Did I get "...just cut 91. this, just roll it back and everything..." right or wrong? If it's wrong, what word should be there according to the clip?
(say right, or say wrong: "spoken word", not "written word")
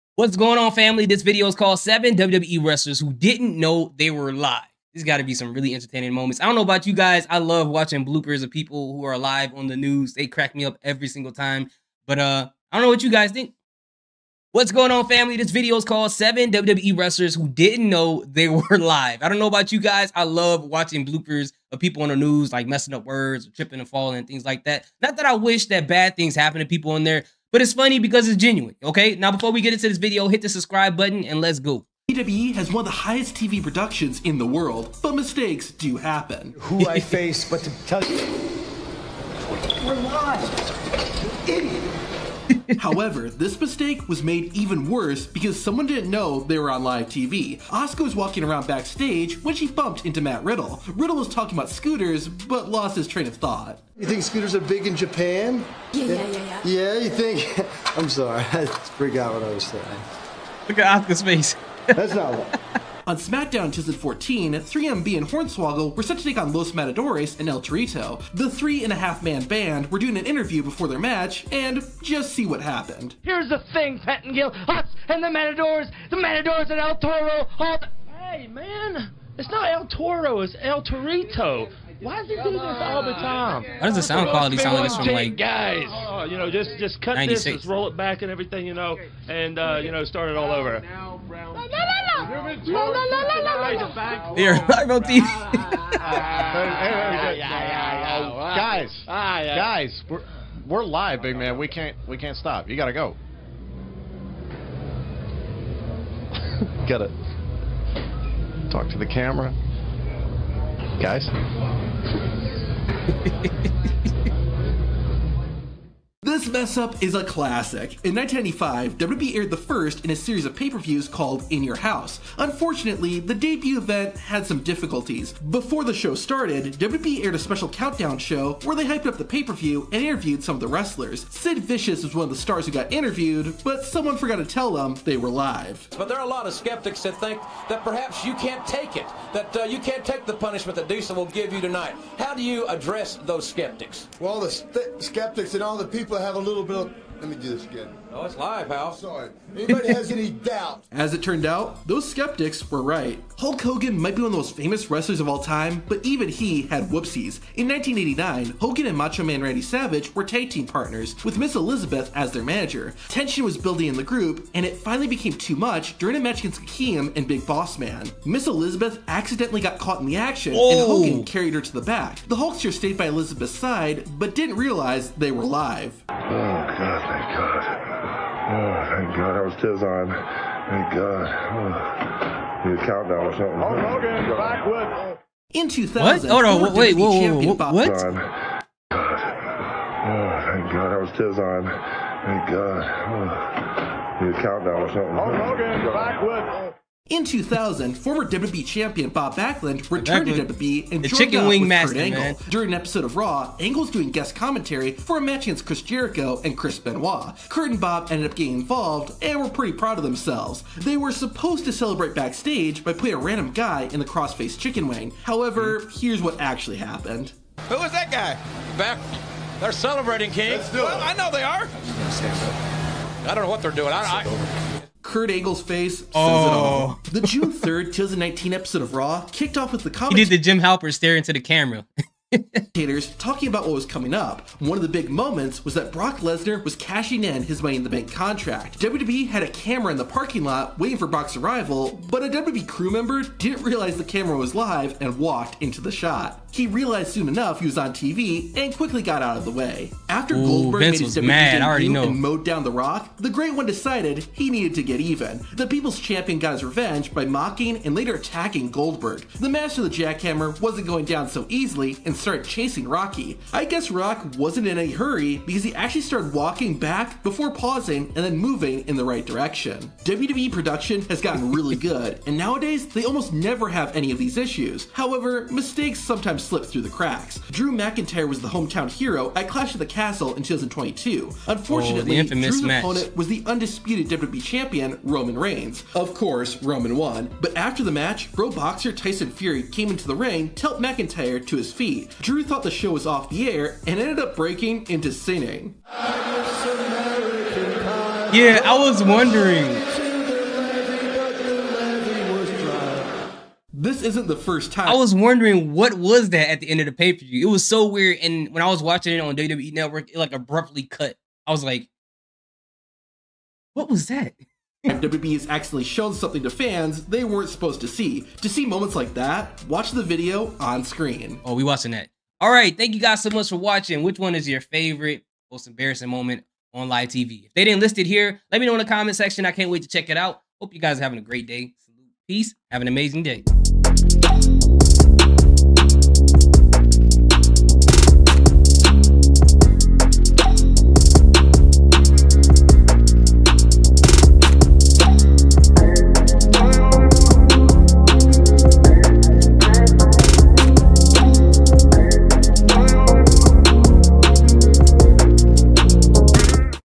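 wrong: "96", not "91".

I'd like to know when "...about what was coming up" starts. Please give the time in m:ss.
3:53.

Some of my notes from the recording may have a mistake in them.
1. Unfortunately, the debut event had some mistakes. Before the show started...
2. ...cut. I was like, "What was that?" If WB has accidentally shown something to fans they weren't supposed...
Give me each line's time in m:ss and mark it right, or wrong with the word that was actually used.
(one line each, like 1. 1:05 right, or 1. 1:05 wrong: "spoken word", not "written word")
1. 2:02 wrong: "difficulties", not "mistakes"
2. 5:10 right.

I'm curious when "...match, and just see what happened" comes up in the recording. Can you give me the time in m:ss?
1:10.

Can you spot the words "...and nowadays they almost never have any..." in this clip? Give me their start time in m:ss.
4:32.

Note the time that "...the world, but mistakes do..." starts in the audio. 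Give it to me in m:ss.
0:34.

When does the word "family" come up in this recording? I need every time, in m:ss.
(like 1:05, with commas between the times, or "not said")
0:00, 0:15.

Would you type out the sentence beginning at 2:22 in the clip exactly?
How do you address those skeptics?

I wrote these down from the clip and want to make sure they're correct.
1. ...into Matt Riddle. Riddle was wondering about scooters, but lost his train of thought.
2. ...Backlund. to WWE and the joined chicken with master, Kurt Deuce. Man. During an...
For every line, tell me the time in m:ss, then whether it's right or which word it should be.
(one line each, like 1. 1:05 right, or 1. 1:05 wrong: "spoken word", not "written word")
1. 0:50 wrong: "talking", not "wondering"
2. 3:20 wrong: "Angle", not "Deuce".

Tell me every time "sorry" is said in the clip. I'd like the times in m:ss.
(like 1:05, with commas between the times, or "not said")
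0:58, 2:28.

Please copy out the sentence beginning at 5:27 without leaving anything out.
If they didn't list it here, let me know in the comment section.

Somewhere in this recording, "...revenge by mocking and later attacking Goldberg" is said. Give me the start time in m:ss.
4:16.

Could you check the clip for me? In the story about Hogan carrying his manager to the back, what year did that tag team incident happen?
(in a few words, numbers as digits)
1989.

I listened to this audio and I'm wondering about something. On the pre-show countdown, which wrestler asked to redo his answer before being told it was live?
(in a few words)
Sid Vicious.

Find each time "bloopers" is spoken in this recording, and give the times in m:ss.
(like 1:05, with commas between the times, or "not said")
0:08, 0:21.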